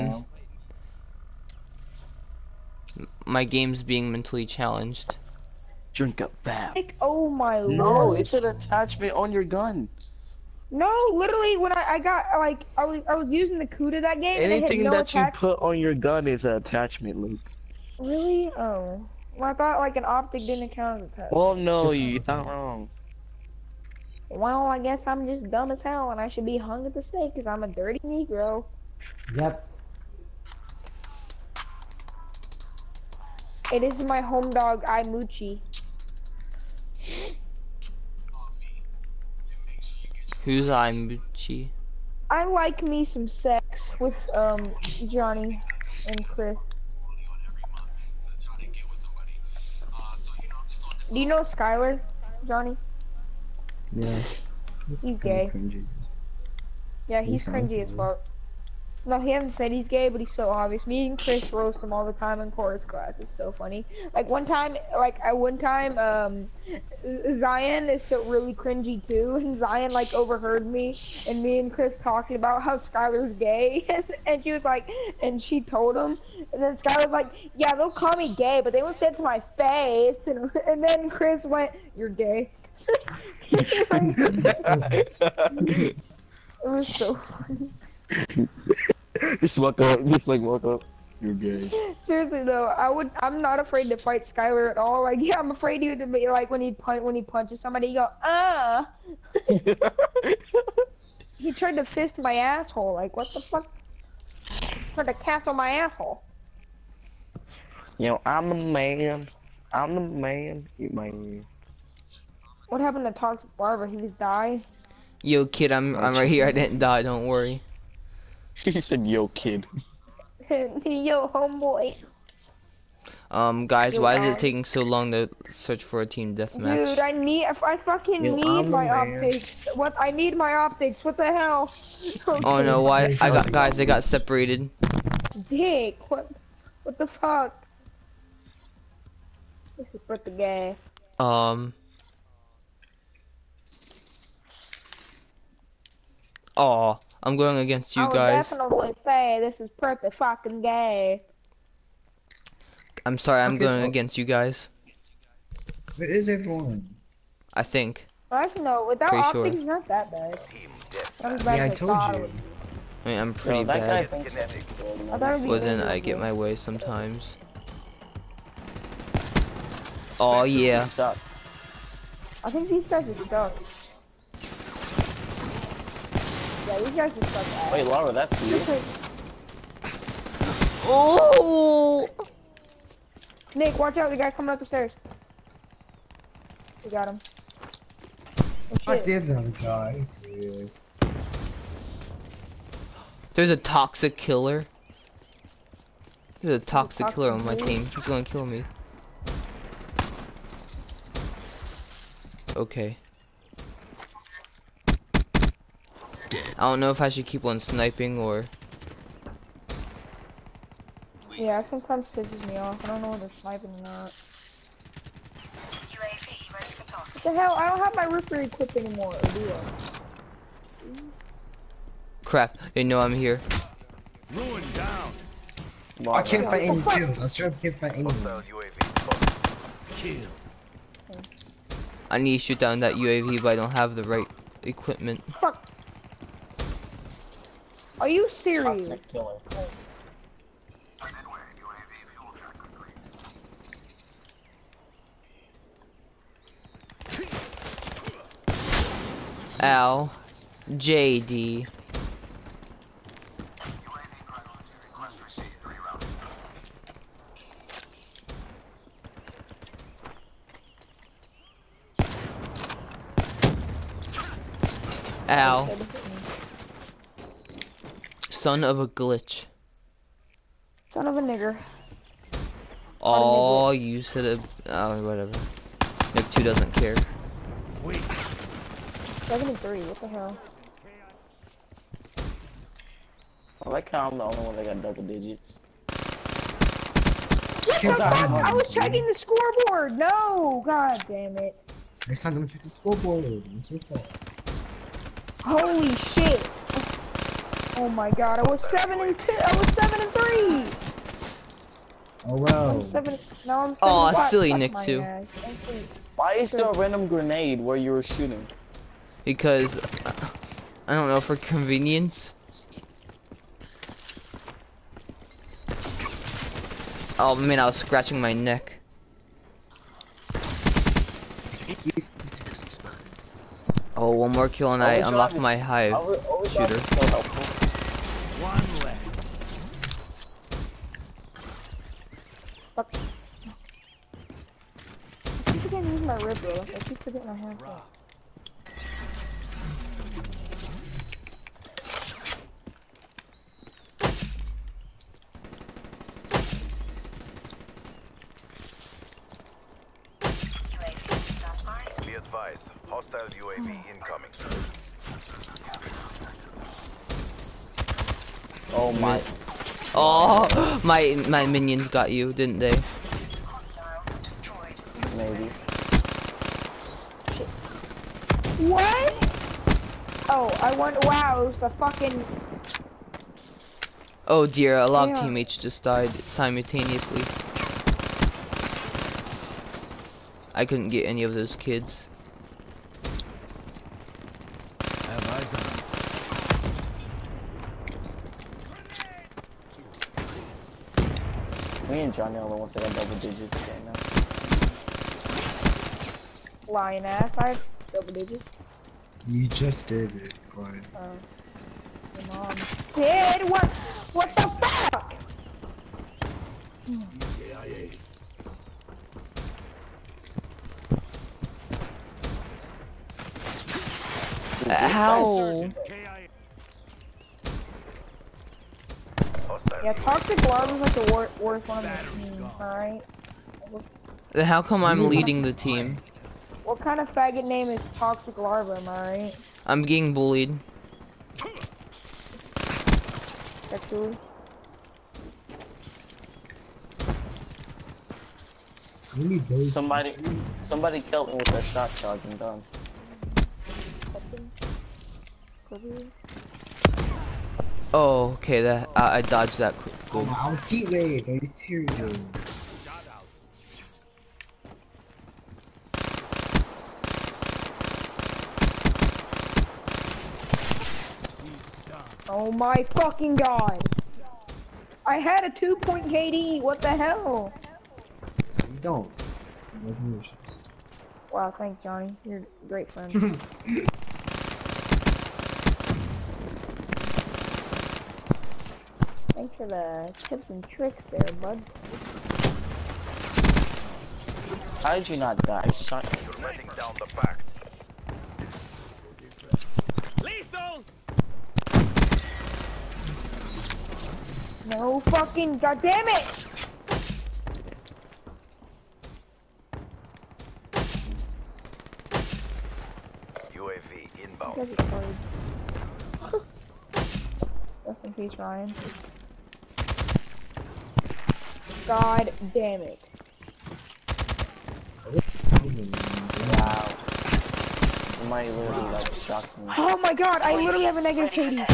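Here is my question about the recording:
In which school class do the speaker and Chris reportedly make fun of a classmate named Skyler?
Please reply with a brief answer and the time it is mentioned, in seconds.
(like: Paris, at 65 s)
Chorus class, at 62 s.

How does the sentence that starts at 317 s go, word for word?
Oh man, I was scratching my neck.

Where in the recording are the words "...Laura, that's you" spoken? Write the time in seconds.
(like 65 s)
177 s.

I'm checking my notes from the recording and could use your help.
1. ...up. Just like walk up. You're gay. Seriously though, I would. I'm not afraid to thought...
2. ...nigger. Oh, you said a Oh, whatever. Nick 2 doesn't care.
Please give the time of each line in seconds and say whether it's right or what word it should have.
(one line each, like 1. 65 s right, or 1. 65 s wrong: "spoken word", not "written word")
1. 89 s wrong: "fight", not "thought"
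2. 271 s right.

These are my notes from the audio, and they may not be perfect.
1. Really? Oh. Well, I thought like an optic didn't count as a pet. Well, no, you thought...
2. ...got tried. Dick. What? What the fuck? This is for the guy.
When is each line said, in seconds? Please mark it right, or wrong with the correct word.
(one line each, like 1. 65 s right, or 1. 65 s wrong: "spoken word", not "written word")
1. 17 s right
2. 133 s wrong: "separated", not "tried".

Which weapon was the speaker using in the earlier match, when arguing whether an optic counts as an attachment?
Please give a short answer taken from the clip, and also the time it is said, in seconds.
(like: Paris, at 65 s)
Kuda, at 13 s.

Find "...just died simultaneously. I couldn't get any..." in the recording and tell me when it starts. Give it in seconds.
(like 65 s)
375 s.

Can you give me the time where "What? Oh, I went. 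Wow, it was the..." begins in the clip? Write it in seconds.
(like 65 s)
368 s.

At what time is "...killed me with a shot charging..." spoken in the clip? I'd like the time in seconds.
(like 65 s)
440 s.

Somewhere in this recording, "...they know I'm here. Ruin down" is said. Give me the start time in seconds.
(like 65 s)
222 s.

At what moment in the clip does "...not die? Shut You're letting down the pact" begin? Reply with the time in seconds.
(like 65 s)
485 s.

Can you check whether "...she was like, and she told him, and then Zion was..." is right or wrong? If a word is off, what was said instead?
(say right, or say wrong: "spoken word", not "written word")
wrong: "Skylar", not "Zion".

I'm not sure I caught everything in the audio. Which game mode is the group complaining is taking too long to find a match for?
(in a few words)
Team deathmatch.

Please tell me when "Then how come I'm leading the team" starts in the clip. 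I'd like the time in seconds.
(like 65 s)
424 s.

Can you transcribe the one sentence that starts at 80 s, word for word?
And and then Chris went, you're gay.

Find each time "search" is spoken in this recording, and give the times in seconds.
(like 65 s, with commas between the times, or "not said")
125 s.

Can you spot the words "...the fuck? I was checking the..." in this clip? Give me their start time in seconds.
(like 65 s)
287 s.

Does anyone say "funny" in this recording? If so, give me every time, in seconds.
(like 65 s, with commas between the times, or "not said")
63 s, 87 s.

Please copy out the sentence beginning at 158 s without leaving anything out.
without pretty optics, he's not that bad.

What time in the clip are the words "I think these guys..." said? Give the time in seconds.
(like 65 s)
172 s.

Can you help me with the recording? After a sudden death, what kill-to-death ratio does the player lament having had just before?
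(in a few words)
2.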